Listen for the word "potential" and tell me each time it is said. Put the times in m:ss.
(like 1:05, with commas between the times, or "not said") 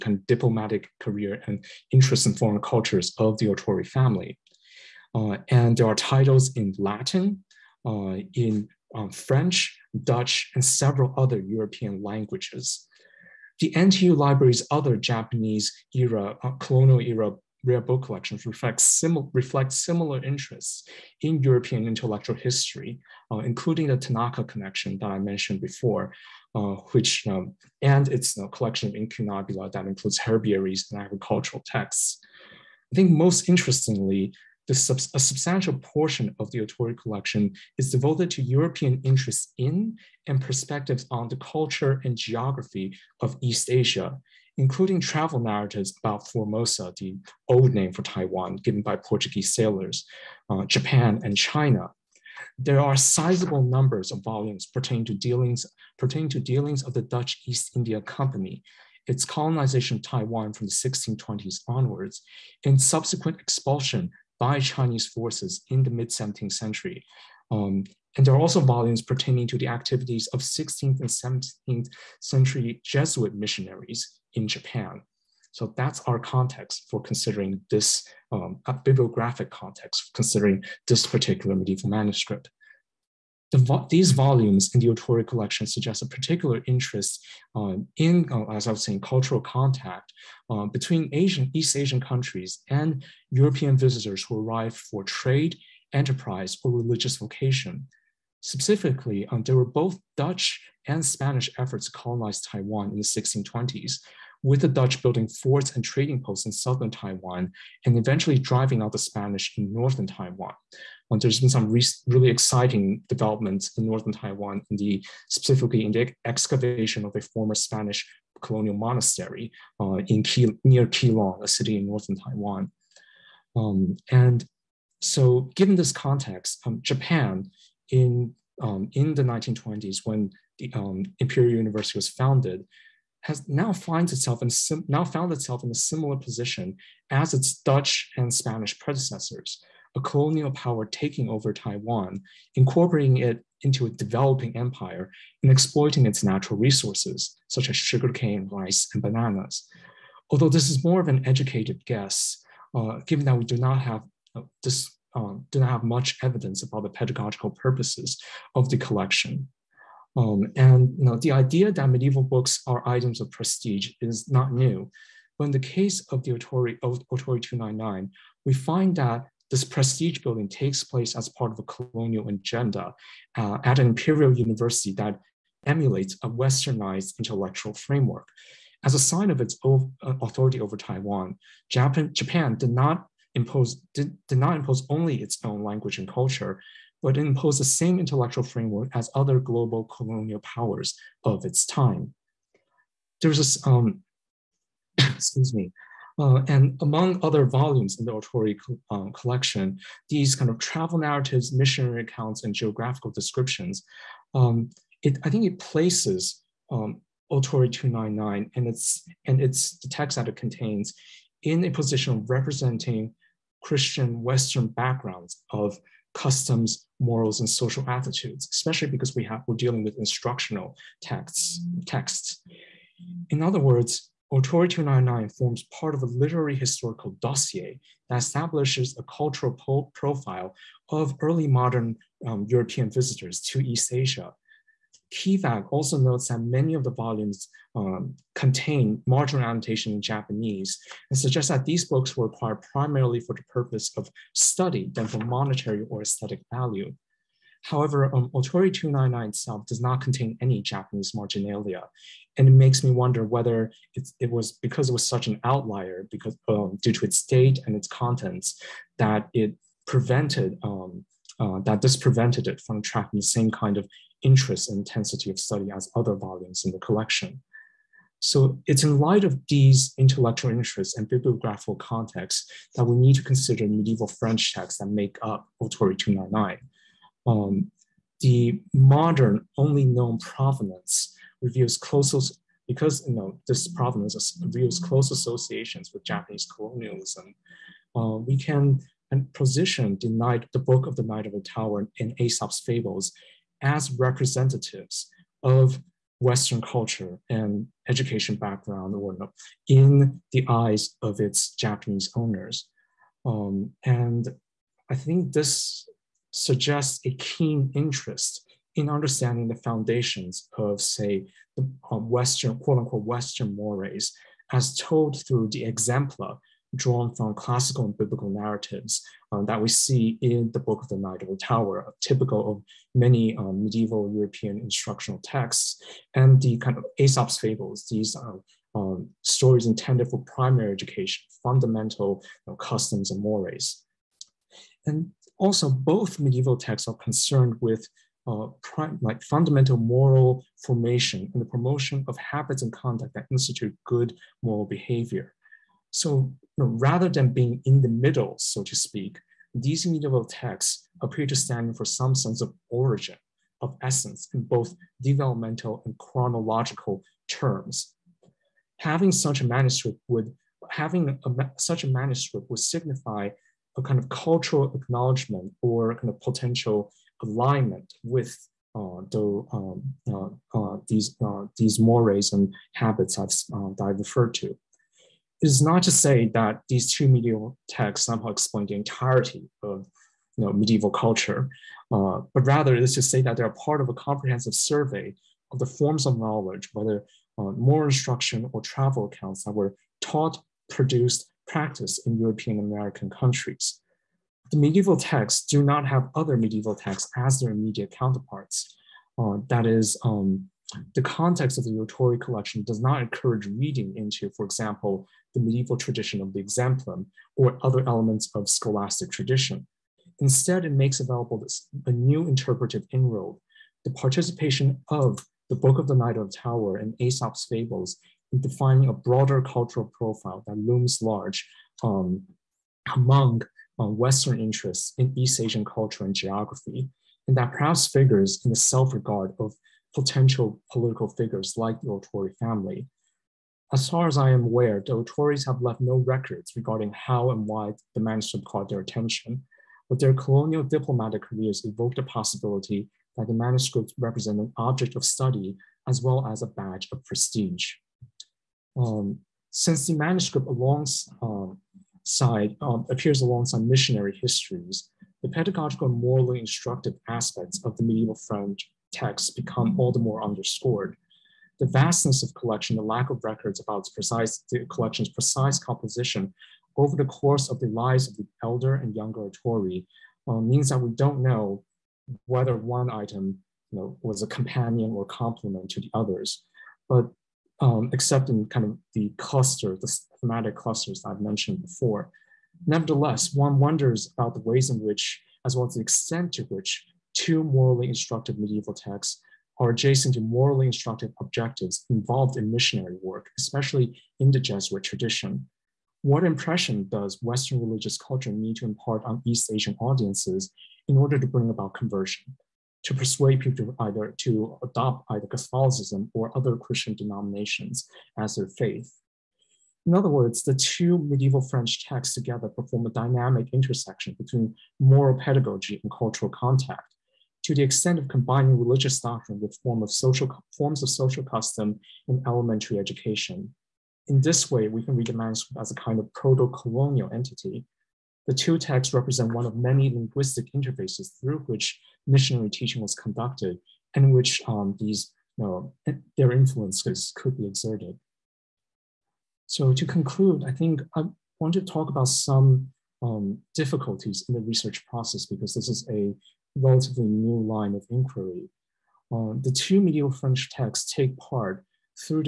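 6:06, 7:09.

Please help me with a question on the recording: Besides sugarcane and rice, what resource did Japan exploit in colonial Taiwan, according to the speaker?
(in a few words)
bananas.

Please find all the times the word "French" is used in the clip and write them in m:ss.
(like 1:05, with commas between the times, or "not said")
0:09, 4:34, 7:38, 8:31, 9:10.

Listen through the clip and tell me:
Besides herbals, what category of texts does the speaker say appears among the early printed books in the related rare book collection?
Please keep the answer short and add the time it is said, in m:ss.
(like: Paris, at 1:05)
agricultural texts, at 0:31.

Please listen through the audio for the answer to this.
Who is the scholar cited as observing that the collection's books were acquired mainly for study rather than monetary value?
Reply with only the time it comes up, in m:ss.
3:55.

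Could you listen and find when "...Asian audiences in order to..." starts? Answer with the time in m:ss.
8:19.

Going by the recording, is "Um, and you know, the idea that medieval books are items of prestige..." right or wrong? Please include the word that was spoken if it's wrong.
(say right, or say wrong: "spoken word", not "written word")
right.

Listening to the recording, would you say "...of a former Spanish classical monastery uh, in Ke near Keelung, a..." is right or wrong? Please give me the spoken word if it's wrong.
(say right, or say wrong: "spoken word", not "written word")
wrong: "colonial", not "classical".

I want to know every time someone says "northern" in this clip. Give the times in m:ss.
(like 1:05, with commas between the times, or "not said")
1:49, 1:53, 2:01.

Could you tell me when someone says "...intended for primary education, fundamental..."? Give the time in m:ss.
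5:29.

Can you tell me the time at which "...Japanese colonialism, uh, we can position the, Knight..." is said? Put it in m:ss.
4:46.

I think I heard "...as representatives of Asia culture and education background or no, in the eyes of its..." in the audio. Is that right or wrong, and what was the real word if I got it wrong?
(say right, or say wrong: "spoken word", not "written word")
wrong: "Western", not "Asia".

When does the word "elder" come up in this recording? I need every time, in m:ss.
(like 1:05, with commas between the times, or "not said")
7:48.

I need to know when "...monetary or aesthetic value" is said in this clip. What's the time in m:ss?
4:05.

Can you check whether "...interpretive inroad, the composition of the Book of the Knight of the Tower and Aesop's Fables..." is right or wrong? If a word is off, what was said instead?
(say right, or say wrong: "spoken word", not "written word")
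wrong: "participation", not "composition".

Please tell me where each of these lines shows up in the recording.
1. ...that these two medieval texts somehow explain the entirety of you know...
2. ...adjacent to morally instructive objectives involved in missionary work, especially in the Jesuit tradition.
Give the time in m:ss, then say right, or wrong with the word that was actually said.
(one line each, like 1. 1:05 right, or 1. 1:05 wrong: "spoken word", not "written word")
1. 6:16 right
2. 8:09 right.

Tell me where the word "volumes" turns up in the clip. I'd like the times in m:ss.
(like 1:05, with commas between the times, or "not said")
0:54, 1:08, 1:24, 3:17, 3:56, 4:26.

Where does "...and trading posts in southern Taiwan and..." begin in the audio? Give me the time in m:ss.
1:45.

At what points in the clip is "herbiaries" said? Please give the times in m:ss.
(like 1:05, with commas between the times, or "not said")
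0:30.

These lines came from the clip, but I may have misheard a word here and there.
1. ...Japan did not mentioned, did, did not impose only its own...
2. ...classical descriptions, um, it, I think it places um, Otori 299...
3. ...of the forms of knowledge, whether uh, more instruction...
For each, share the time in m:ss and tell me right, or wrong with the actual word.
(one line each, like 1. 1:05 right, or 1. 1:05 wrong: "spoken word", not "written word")
1. 3:02 wrong: "imposed", not "mentioned"
2. 3:22 wrong: "geographical", not "classical"
3. 6:25 right.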